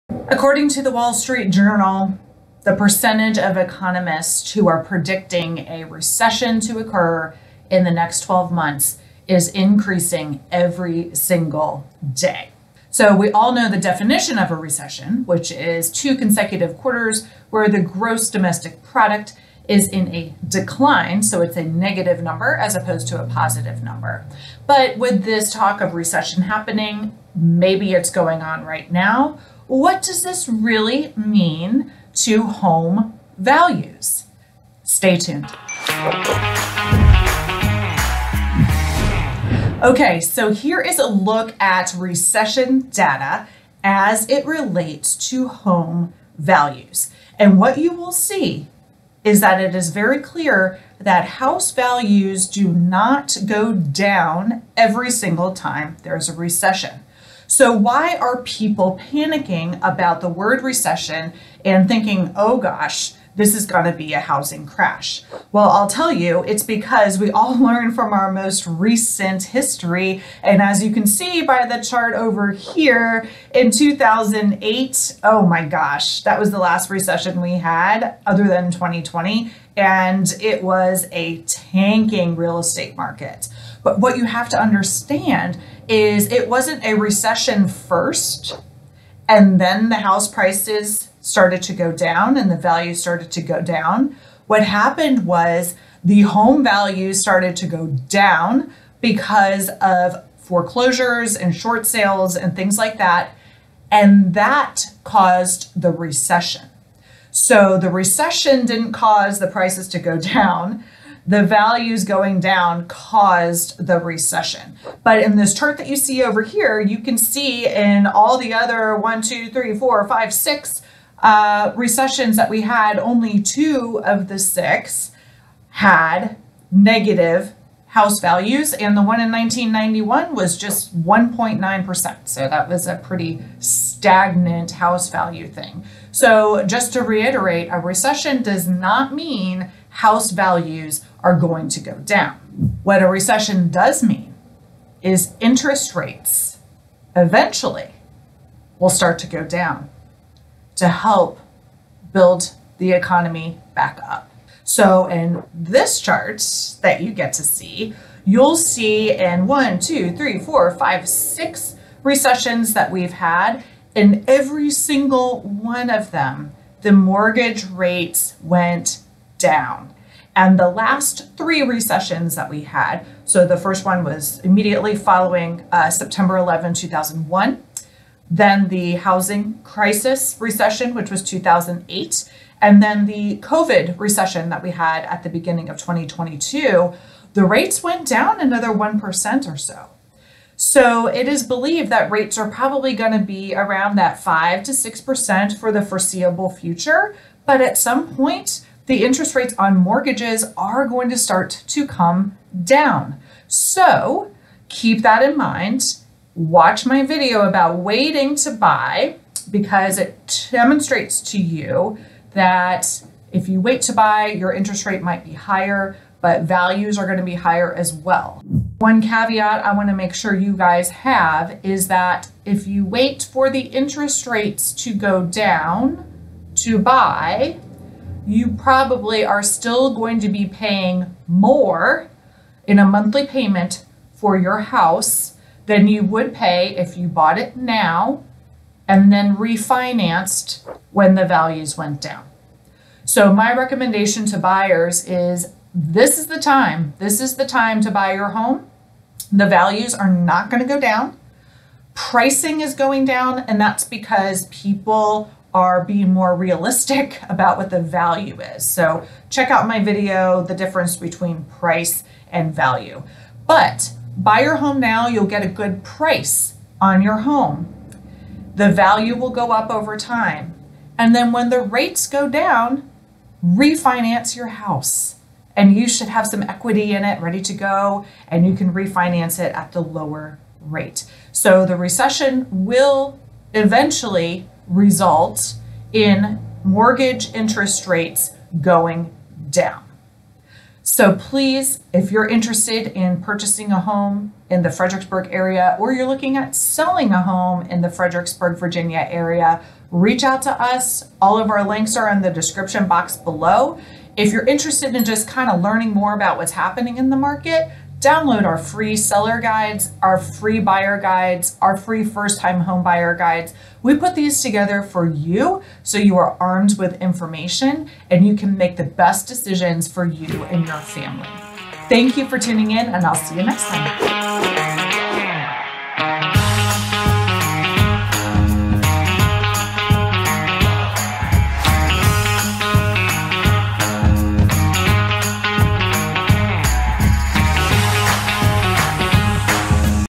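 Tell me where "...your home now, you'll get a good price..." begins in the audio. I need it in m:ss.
4:24.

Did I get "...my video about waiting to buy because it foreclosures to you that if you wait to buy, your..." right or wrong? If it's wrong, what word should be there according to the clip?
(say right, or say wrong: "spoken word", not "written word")
wrong: "demonstrates", not "foreclosures".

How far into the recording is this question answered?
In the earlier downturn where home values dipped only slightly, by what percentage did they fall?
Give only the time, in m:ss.
2:11.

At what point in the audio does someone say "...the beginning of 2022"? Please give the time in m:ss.
3:05.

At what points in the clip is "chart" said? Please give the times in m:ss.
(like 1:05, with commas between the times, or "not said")
1:11, 1:55, 2:35.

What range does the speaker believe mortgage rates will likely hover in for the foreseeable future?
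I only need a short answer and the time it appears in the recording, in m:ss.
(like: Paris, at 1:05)
5 to 6%, at 3:14.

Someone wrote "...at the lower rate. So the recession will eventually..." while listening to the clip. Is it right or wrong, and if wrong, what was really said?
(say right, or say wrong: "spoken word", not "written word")
right.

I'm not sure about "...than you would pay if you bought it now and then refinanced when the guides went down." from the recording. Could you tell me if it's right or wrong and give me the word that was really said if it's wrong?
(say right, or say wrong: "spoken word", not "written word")
wrong: "values", not "guides".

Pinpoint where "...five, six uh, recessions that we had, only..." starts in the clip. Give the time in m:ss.
2:00.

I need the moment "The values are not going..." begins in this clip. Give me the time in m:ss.
4:09.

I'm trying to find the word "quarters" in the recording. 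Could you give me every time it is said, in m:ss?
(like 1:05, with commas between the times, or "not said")
0:16.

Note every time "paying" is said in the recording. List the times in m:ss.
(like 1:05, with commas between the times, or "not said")
3:50.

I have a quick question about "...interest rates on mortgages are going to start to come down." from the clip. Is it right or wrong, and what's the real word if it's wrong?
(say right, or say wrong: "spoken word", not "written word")
right.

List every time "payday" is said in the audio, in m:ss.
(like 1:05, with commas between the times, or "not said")
not said.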